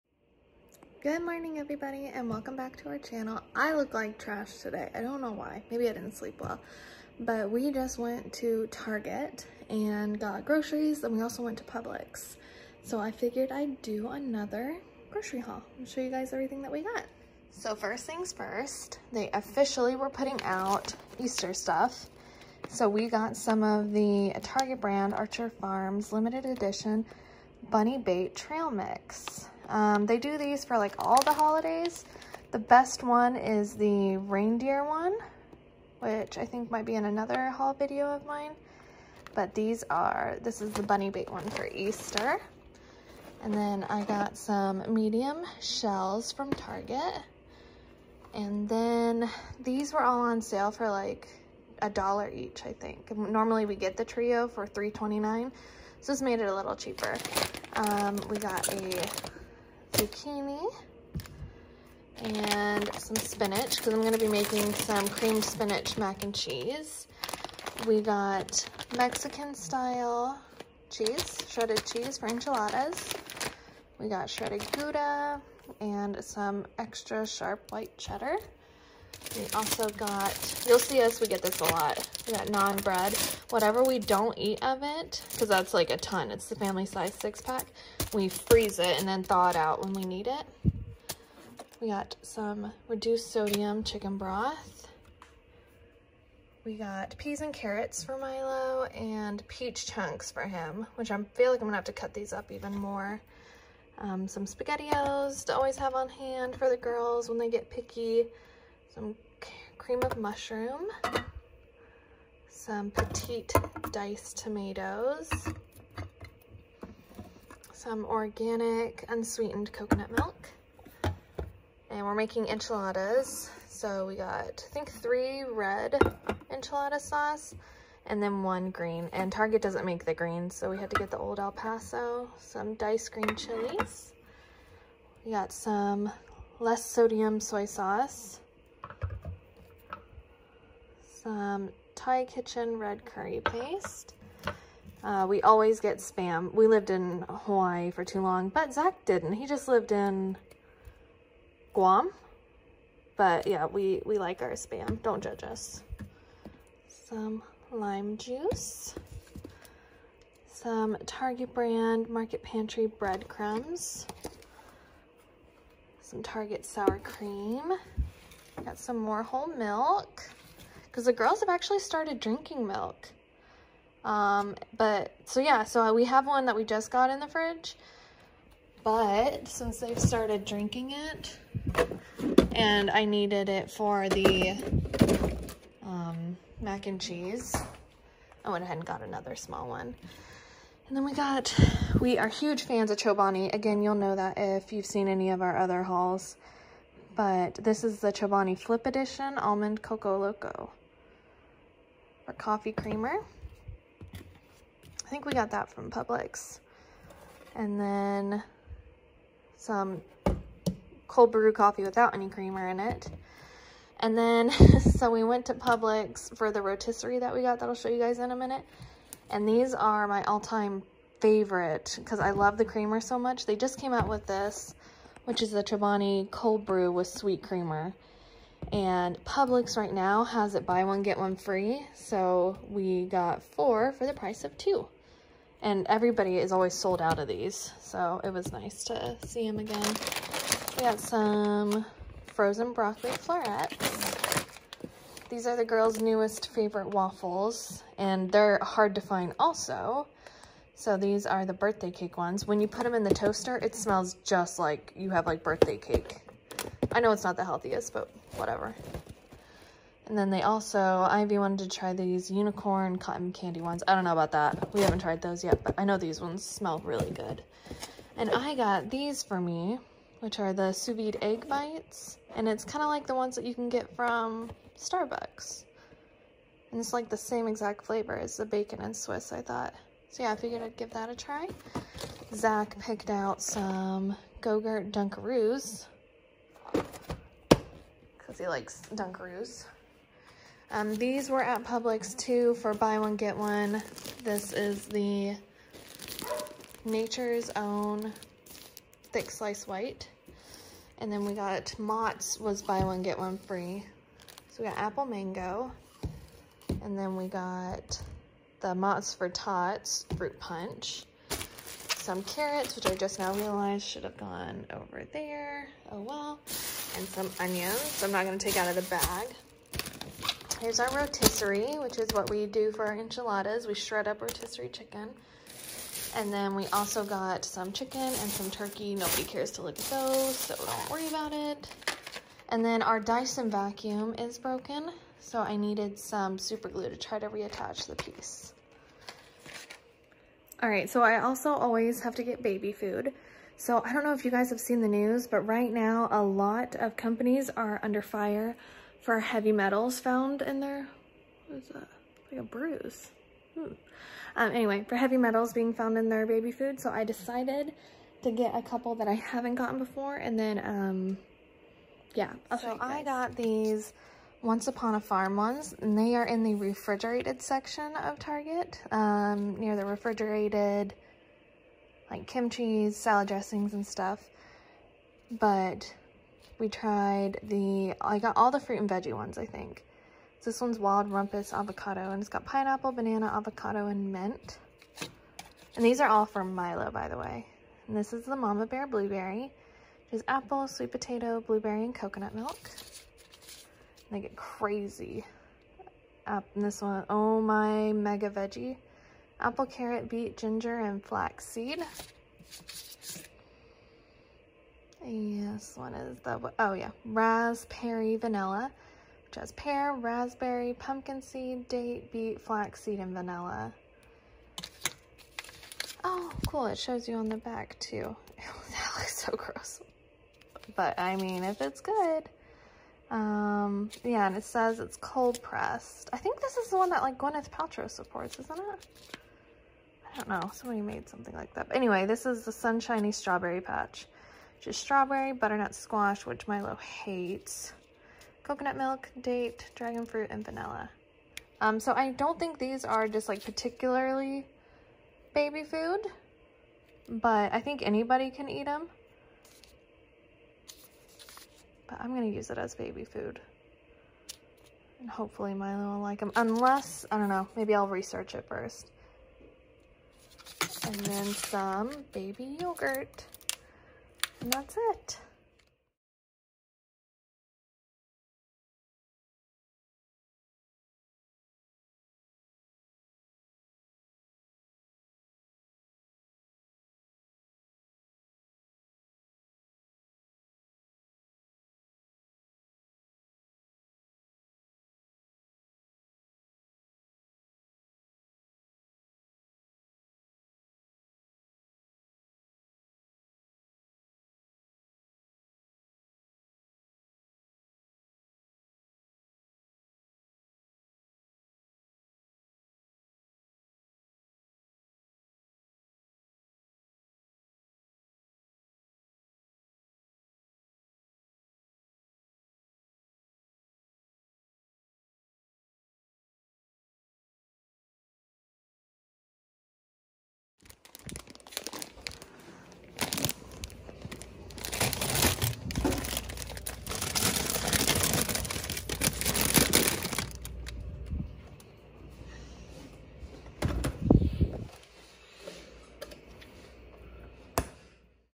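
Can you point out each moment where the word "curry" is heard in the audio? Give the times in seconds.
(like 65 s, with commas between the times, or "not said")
143 s.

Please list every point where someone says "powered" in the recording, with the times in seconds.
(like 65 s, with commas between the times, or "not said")
not said.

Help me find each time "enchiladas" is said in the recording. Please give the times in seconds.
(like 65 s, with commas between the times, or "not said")
72 s, 122 s, 126 s, 322 s.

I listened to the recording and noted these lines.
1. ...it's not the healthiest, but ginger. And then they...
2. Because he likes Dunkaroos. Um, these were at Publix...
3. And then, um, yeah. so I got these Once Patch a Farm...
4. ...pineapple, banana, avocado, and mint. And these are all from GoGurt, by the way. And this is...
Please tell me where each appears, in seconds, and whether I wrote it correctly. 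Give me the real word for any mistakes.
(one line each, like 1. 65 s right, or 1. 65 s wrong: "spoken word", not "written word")
1. 257 s wrong: "whatever", not "ginger"
2. 286 s right
3. 360 s wrong: "Upon", not "Patch"
4. 382 s wrong: "Milo", not "GoGurt".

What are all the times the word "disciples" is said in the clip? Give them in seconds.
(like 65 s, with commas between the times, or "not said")
not said.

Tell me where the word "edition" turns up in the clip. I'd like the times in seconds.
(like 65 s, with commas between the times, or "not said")
26 s, 198 s.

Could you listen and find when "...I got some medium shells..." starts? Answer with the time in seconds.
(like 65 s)
43 s.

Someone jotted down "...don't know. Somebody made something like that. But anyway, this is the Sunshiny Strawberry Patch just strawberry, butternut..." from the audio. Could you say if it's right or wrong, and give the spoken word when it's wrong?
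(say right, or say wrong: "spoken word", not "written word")
right.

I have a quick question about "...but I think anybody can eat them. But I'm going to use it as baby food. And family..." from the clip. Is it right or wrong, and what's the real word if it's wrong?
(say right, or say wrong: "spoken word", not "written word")
wrong: "hopefully", not "family".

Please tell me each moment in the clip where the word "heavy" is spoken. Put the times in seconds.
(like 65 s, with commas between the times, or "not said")
349 s, 354 s.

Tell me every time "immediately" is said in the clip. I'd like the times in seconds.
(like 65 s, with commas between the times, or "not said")
not said.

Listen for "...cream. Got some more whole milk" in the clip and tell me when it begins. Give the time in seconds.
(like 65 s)
166 s.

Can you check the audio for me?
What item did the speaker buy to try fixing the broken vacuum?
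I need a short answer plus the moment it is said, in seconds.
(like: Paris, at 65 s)
super glue, at 336 s.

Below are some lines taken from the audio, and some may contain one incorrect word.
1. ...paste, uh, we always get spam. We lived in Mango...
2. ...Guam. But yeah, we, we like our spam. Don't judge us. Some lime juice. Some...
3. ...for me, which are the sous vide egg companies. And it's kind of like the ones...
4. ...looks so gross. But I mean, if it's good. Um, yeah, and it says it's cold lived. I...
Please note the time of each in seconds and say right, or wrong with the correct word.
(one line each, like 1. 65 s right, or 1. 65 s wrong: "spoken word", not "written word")
1. 143 s wrong: "Hawaii", not "Mango"
2. 151 s right
3. 269 s wrong: "bites", not "companies"
4. 418 s wrong: "pressed", not "lived".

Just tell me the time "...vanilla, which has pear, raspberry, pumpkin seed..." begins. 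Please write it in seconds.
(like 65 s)
408 s.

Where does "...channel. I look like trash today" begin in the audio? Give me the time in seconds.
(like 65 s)
2 s.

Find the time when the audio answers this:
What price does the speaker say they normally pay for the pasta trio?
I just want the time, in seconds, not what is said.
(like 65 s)
54 s.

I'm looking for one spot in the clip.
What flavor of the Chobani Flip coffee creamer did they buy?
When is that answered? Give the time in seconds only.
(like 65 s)
199 s.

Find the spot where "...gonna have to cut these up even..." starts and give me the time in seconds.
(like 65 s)
101 s.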